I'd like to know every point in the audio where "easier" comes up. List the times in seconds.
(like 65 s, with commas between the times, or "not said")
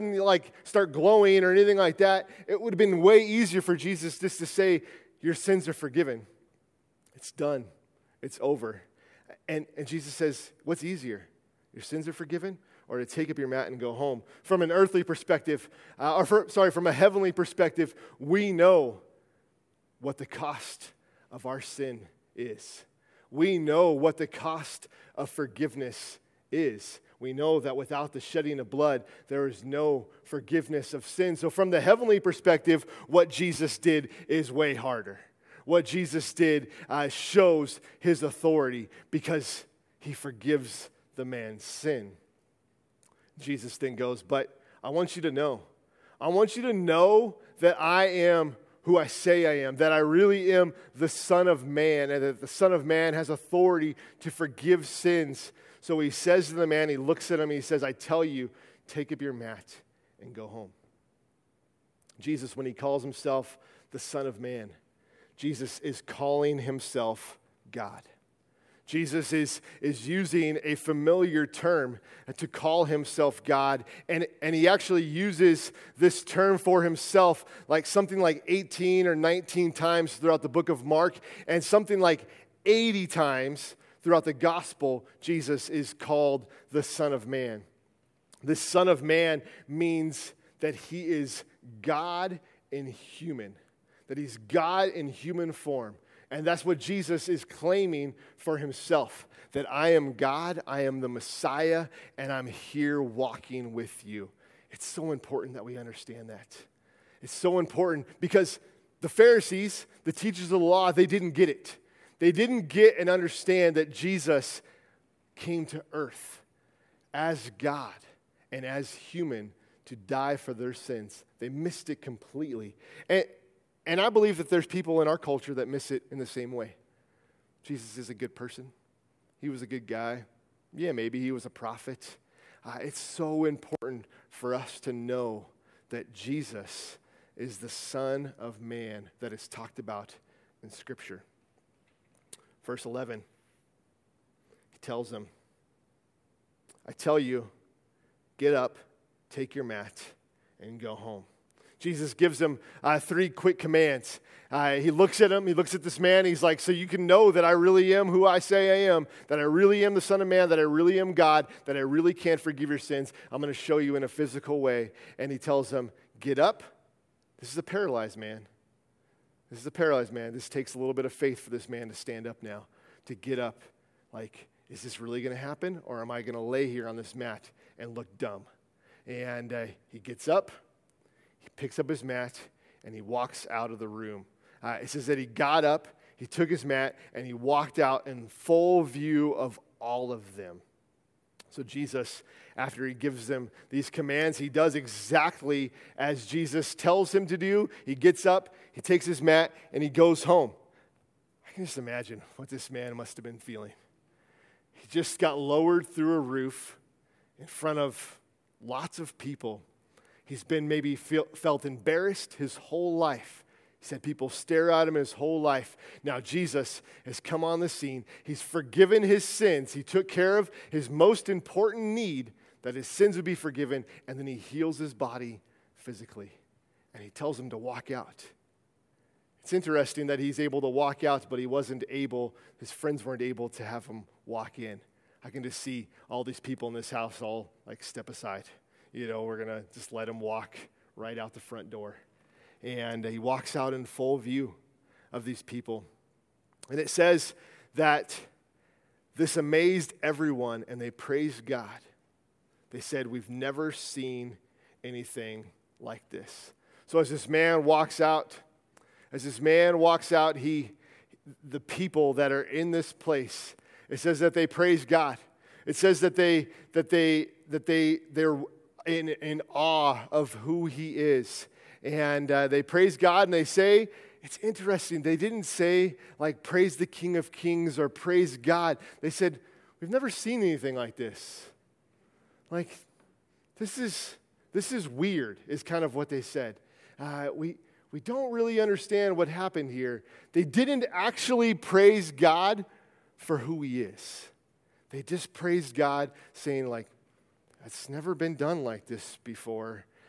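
3 s, 10 s.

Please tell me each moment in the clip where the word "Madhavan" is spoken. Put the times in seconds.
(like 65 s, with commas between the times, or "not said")
not said.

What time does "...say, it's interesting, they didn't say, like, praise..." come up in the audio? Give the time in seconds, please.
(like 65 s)
273 s.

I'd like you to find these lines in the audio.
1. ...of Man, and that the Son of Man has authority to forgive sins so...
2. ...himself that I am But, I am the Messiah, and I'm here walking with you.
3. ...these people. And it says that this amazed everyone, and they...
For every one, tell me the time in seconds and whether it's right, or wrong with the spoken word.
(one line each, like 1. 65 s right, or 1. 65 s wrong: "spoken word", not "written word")
1. 51 s right
2. 98 s wrong: "God", not "But"
3. 245 s right.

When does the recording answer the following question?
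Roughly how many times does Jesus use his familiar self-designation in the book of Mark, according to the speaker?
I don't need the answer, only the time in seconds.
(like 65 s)
78 s.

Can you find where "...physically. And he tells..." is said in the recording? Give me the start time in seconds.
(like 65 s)
225 s.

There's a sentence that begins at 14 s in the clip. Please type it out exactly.
From an earthly perspective, uh, or for, sorry, from a heavenly perspective, we know what the cost of our sin is.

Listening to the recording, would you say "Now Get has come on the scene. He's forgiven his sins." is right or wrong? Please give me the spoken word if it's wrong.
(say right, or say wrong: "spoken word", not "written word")
wrong: "Jesus", not "Get".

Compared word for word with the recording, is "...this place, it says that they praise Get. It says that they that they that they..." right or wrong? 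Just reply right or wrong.
wrong.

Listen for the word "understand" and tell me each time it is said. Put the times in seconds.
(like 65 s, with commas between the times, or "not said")
105 s, 113 s, 288 s.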